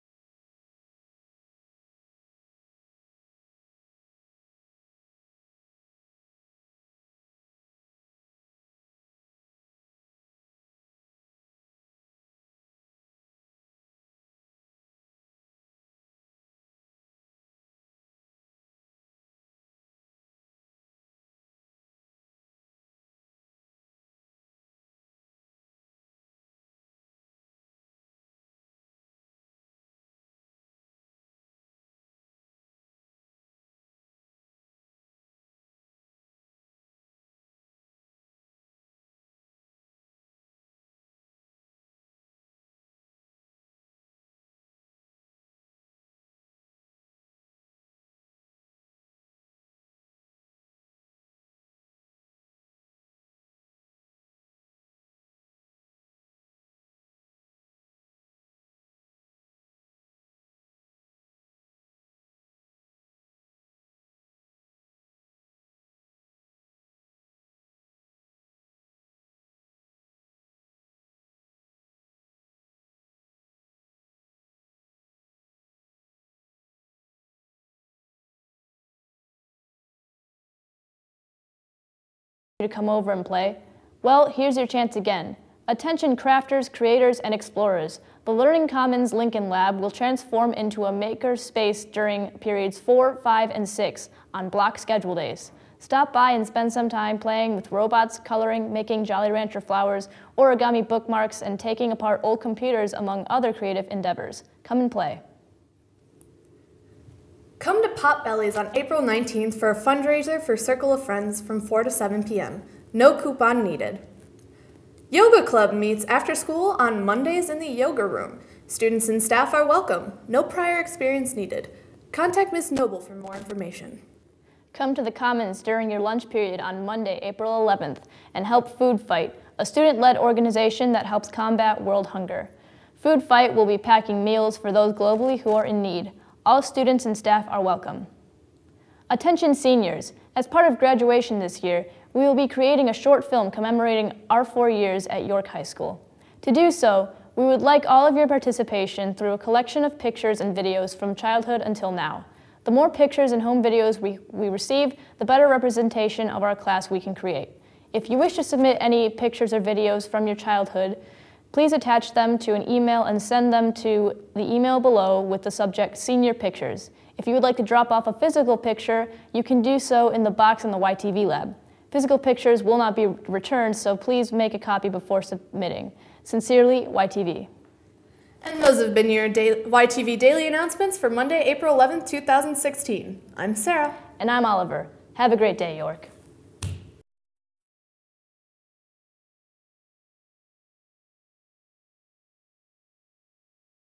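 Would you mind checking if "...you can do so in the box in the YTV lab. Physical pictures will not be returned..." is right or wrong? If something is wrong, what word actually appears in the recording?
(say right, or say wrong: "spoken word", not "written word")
right.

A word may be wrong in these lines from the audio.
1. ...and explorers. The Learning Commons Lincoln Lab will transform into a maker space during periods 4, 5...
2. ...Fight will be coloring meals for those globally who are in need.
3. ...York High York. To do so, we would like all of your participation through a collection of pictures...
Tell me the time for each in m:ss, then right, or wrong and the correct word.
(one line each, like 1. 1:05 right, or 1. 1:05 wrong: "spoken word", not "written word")
1. 1:27 right
2. 2:13 wrong: "packing", not "coloring"
3. 2:25 wrong: "School", not "York".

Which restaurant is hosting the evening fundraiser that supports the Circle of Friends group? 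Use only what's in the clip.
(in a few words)
Potbelly's.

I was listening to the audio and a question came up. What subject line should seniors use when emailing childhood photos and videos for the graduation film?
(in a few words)
Senior Pictures.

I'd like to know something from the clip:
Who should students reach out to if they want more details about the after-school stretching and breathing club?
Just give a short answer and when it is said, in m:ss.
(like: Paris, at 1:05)
Ms. Noble, at 2:02.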